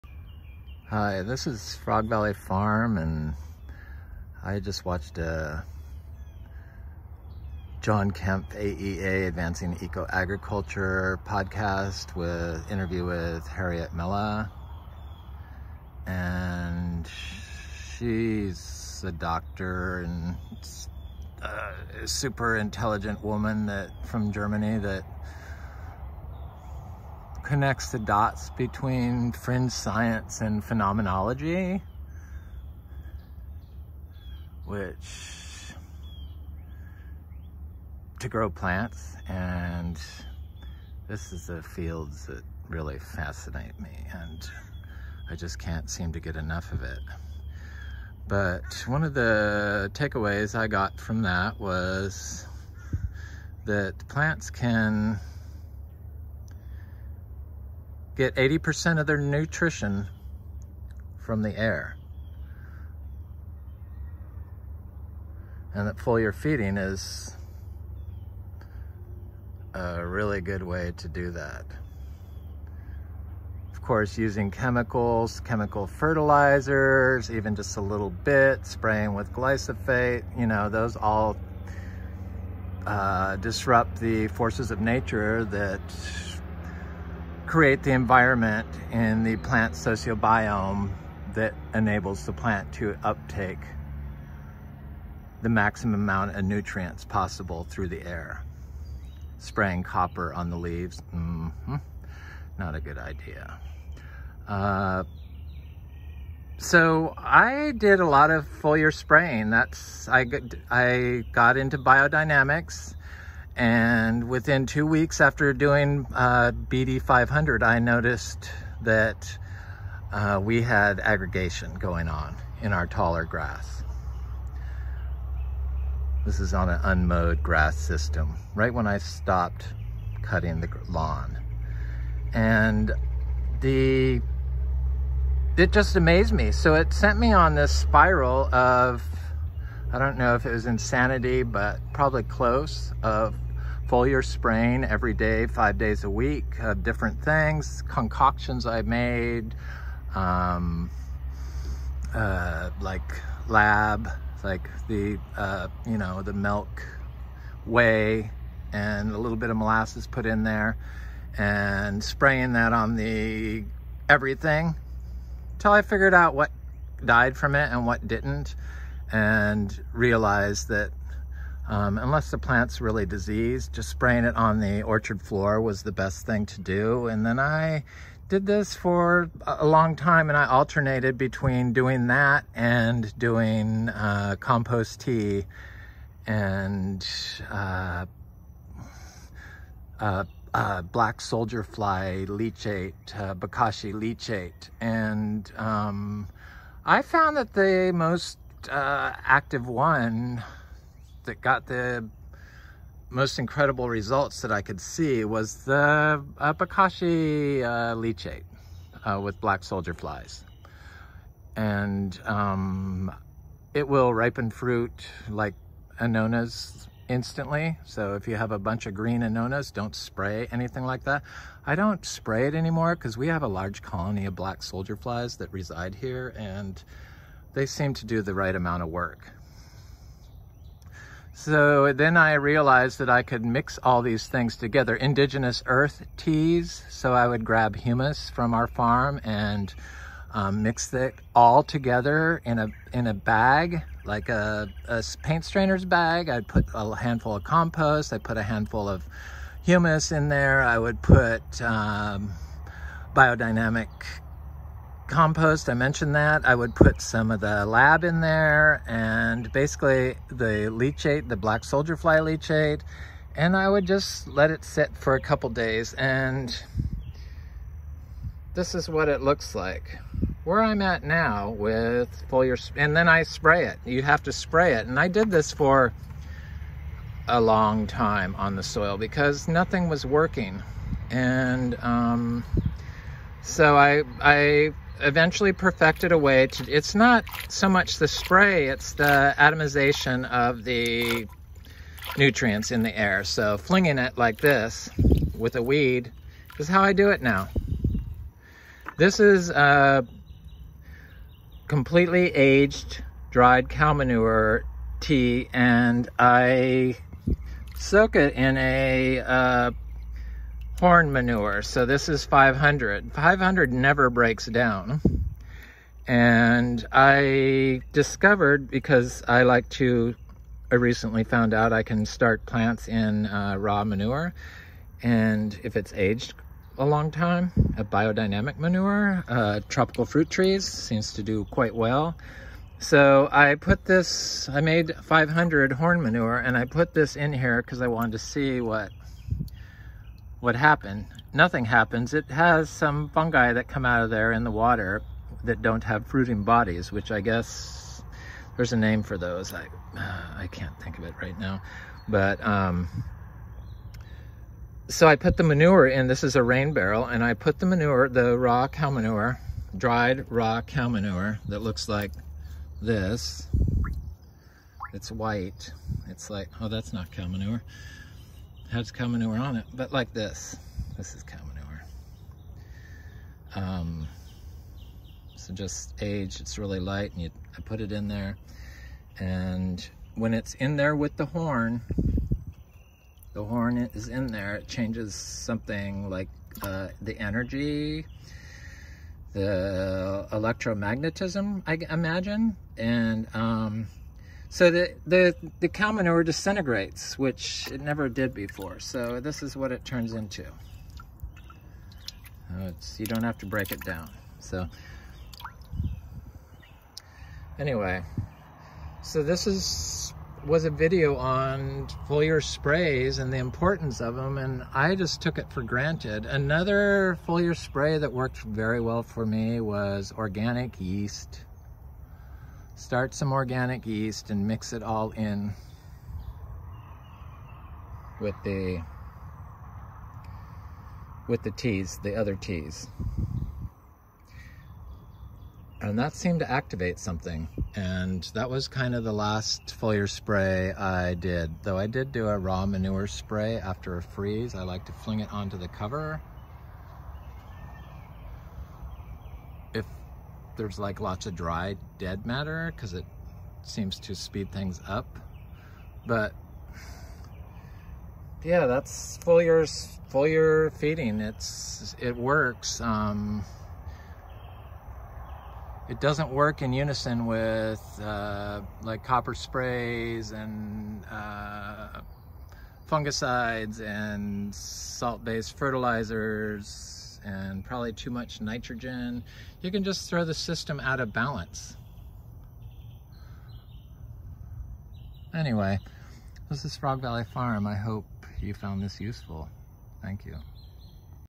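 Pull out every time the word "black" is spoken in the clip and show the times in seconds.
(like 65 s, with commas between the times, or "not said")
190 s, 209 s, 224 s, 261 s.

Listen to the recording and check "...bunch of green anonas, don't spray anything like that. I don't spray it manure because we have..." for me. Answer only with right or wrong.
wrong.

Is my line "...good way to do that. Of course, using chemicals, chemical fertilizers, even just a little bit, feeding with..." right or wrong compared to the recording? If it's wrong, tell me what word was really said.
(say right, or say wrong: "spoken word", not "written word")
wrong: "spraying", not "feeding".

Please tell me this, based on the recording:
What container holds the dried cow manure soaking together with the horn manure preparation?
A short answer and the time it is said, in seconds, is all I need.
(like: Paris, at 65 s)
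rain barrel, at 356 s.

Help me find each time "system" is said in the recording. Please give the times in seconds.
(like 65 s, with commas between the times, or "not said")
127 s, 480 s.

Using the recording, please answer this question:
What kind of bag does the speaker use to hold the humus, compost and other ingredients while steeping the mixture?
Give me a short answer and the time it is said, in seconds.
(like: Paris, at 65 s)
paint strainer bag, at 245 s.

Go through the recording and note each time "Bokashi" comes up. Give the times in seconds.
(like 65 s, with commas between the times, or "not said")
193 s, 206 s.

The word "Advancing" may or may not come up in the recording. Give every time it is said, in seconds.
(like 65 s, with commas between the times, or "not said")
9 s.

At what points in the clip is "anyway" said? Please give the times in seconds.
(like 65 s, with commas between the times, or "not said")
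407 s, 485 s.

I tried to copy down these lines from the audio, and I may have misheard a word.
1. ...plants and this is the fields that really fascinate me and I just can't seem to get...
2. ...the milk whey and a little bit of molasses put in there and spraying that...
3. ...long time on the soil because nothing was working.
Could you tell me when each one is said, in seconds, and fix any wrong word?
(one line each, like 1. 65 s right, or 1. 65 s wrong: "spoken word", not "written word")
1. 38 s right
2. 156 s right
3. 277 s right.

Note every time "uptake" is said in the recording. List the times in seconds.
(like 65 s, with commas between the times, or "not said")
93 s.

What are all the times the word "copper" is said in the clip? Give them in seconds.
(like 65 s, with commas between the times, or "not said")
99 s, 469 s.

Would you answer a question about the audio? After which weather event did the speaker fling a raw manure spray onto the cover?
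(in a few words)
a freeze.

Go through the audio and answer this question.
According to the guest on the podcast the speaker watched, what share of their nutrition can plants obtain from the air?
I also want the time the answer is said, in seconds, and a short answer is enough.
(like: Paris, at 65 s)
80%, at 58 s.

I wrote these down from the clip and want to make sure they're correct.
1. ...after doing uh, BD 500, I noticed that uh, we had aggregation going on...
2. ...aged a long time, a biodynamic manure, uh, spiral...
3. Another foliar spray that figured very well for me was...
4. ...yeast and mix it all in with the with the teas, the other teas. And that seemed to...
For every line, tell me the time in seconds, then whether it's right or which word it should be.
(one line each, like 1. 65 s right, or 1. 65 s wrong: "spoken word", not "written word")
1. 115 s right
2. 325 s wrong: "tropical", not "spiral"
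3. 416 s wrong: "worked", not "figured"
4. 423 s right.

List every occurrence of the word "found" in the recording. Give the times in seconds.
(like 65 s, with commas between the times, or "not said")
197 s, 321 s, 488 s.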